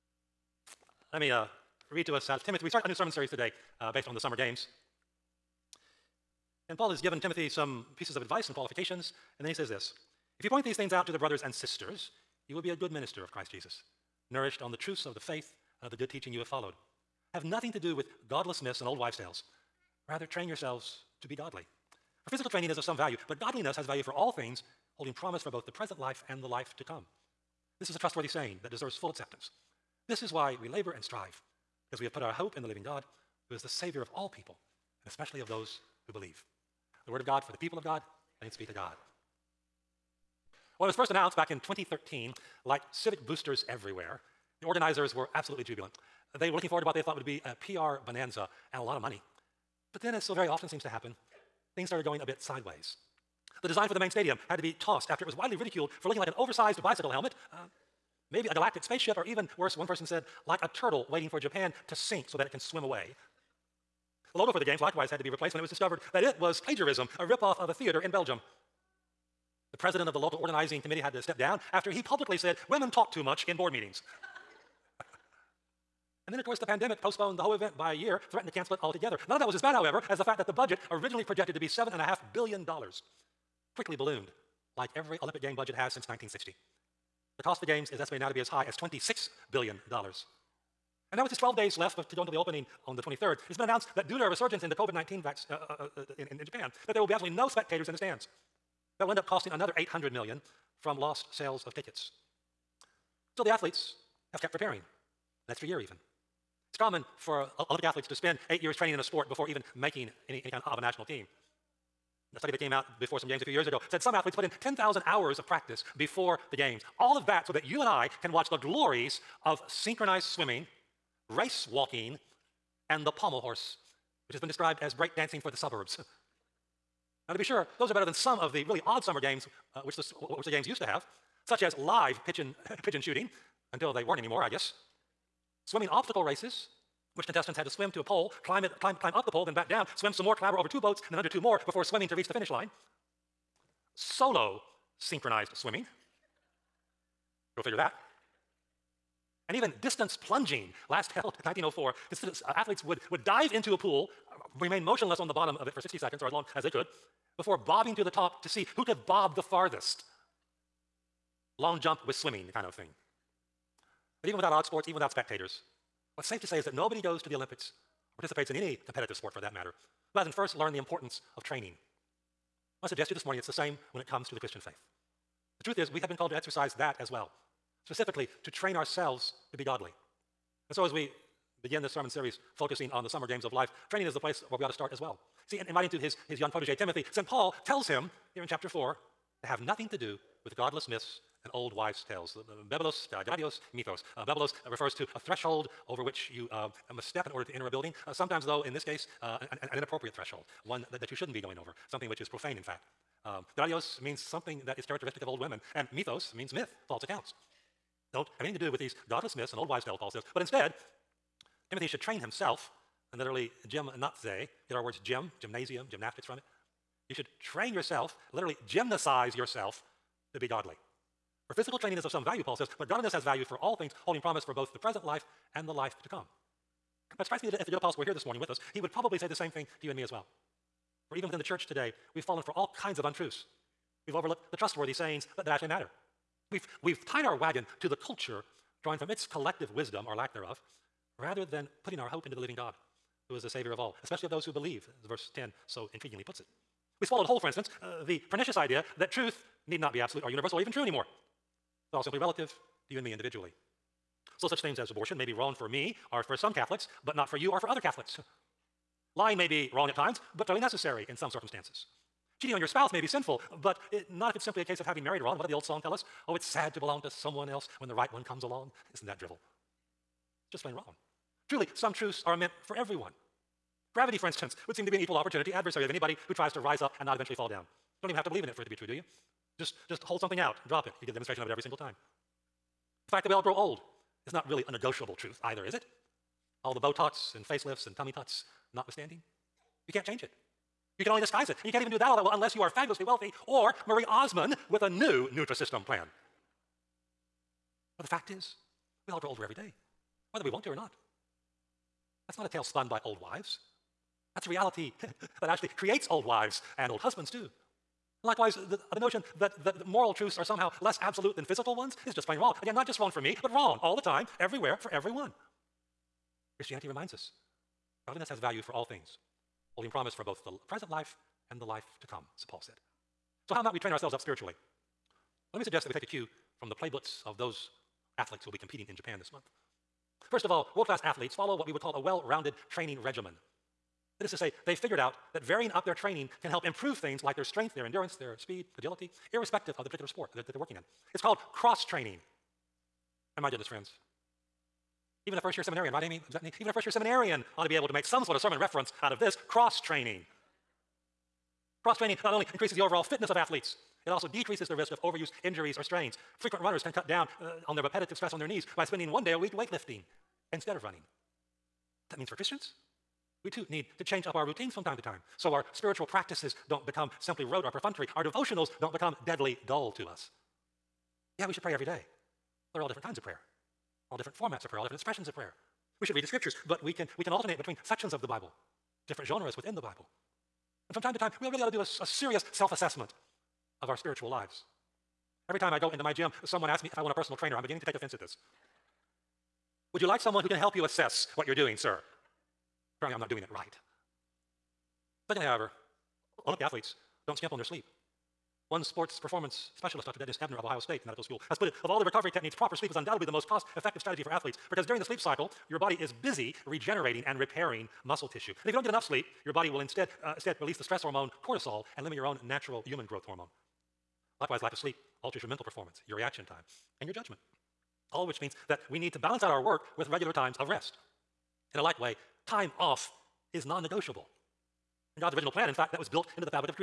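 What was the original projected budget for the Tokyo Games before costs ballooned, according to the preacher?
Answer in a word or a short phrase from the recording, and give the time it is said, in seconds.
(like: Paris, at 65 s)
$7.5 billion, at 81 s.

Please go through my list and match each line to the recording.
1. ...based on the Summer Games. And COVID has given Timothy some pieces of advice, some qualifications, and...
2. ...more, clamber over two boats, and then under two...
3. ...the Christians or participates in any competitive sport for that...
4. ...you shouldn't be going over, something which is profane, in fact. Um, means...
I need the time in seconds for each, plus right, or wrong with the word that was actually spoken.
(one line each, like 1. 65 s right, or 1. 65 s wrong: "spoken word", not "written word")
1. 3 s wrong: "Paul", not "COVID"
2. 140 s right
3. 167 s wrong: "Olympics", not "Christians"
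4. 201 s right.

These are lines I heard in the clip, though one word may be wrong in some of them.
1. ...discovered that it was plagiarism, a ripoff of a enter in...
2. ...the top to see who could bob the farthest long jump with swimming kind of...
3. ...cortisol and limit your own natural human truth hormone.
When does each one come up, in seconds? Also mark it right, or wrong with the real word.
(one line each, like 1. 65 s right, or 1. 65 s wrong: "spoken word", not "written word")
1. 65 s wrong: "theater", not "enter"
2. 158 s right
3. 411 s wrong: "growth", not "truth".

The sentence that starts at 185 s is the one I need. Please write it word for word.
See, in, in writing to his, his young protege Timothy, St.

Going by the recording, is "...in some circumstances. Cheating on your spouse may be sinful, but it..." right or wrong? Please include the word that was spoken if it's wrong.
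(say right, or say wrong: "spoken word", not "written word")
right.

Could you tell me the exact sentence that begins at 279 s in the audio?
Just, just hold something out, drop it.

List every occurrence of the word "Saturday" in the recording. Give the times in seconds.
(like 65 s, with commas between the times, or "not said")
not said.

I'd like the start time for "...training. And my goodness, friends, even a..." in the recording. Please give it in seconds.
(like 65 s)
341 s.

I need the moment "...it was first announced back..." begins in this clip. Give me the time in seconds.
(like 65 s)
40 s.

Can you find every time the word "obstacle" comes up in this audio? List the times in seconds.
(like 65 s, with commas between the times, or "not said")
135 s.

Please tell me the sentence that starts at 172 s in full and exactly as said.
I suggest to you this morning it's the same when it comes to the Christian faith.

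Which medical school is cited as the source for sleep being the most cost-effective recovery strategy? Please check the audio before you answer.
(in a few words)
Ohio State Medical School.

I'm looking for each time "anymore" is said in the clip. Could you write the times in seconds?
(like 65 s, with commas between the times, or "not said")
134 s, 250 s.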